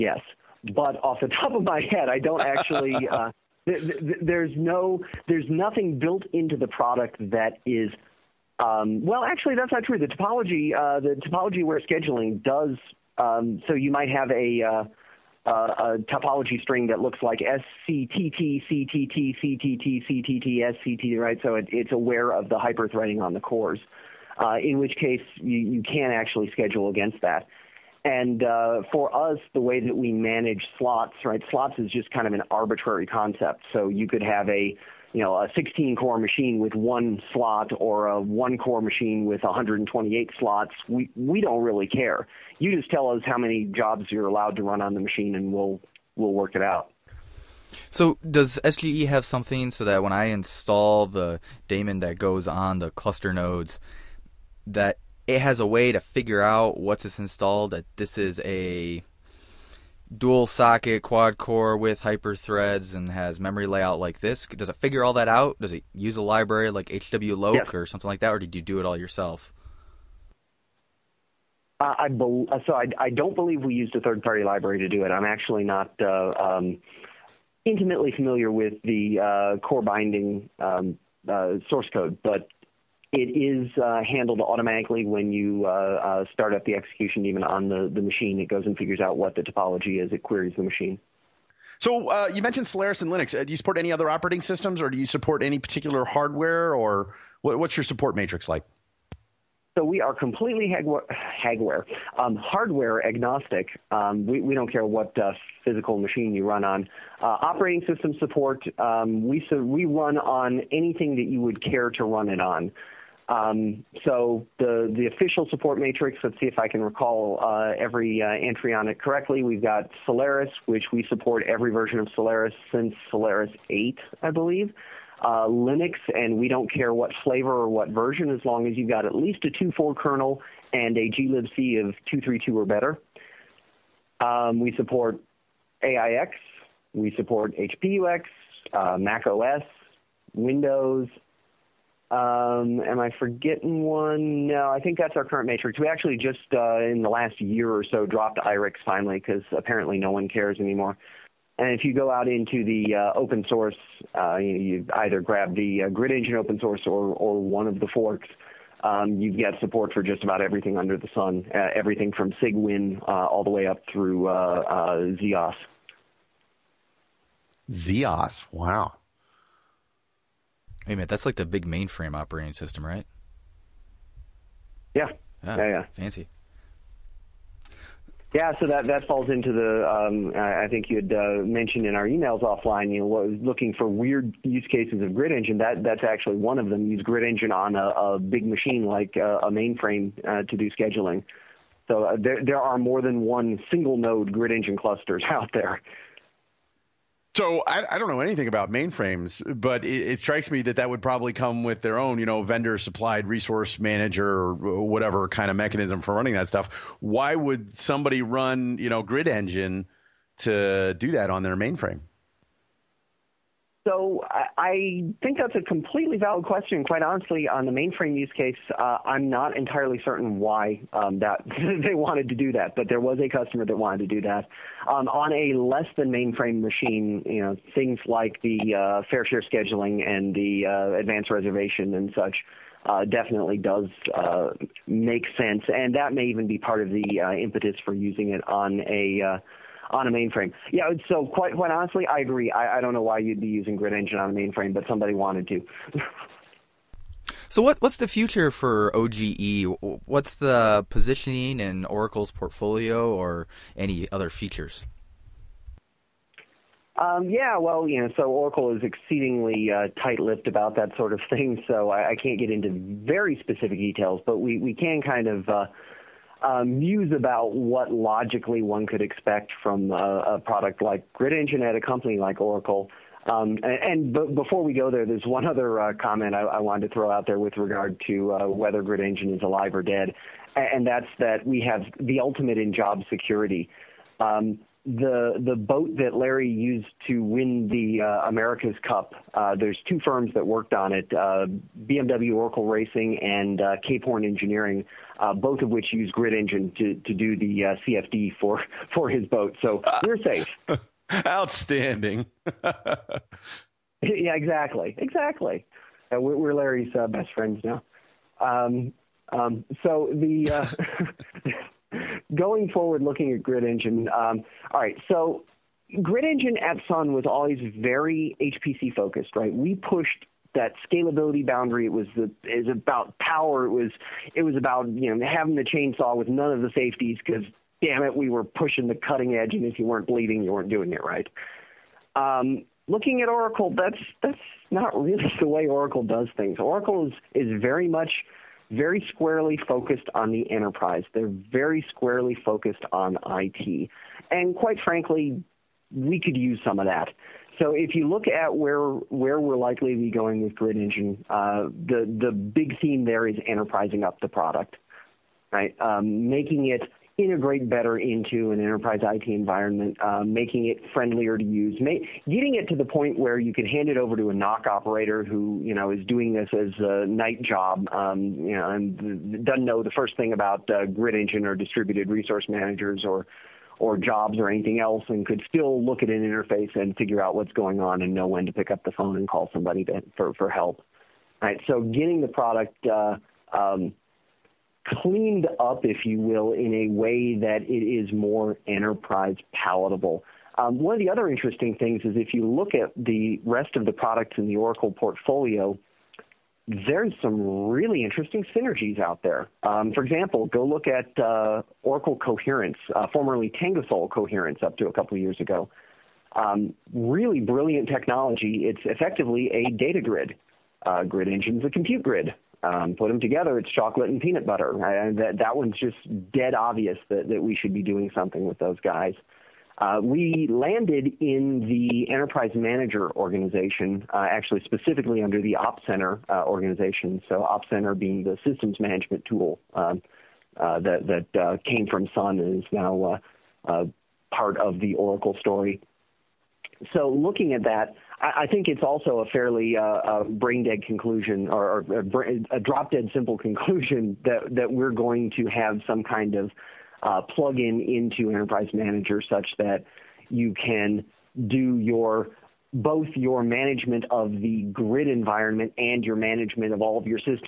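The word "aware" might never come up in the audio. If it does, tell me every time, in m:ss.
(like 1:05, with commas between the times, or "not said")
0:11, 0:21.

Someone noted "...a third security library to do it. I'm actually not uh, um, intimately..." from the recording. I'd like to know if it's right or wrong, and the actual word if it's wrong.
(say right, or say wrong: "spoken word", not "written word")
wrong: "party", not "security".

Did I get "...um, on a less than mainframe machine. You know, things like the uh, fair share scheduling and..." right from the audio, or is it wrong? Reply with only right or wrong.
right.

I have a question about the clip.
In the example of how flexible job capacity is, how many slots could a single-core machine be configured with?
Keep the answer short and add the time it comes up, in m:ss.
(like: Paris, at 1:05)
128, at 0:39.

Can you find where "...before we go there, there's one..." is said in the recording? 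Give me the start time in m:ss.
4:34.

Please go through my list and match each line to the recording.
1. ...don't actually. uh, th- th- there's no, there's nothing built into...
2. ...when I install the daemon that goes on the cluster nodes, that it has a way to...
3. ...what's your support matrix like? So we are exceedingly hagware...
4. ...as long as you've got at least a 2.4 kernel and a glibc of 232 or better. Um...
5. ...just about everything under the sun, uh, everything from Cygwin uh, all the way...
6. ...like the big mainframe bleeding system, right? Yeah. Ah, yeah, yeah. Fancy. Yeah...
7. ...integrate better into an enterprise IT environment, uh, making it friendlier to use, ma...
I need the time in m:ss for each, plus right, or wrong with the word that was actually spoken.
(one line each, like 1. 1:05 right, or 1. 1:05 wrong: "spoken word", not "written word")
1. 0:02 right
2. 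0:50 right
3. 1:37 wrong: "completely", not "exceedingly"
4. 2:08 right
5. 2:40 right
6. 2:51 wrong: "operating", not "bleeding"
7. 5:57 right.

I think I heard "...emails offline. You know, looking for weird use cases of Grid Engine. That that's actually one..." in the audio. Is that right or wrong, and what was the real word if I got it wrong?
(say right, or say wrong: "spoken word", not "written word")
right.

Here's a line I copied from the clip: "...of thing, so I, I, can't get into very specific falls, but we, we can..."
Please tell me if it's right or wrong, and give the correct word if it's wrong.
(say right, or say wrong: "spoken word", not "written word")
wrong: "details", not "falls".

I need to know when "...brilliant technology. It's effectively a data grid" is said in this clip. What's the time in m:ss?
6:47.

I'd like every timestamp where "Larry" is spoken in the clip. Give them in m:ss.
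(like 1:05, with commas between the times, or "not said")
4:46, 5:06.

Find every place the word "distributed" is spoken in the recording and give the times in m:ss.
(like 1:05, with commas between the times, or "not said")
6:11.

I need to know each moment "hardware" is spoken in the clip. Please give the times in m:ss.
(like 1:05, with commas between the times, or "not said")
1:36, 1:42.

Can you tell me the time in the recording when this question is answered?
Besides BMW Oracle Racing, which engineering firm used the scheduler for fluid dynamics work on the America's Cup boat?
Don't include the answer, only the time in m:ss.
4:53.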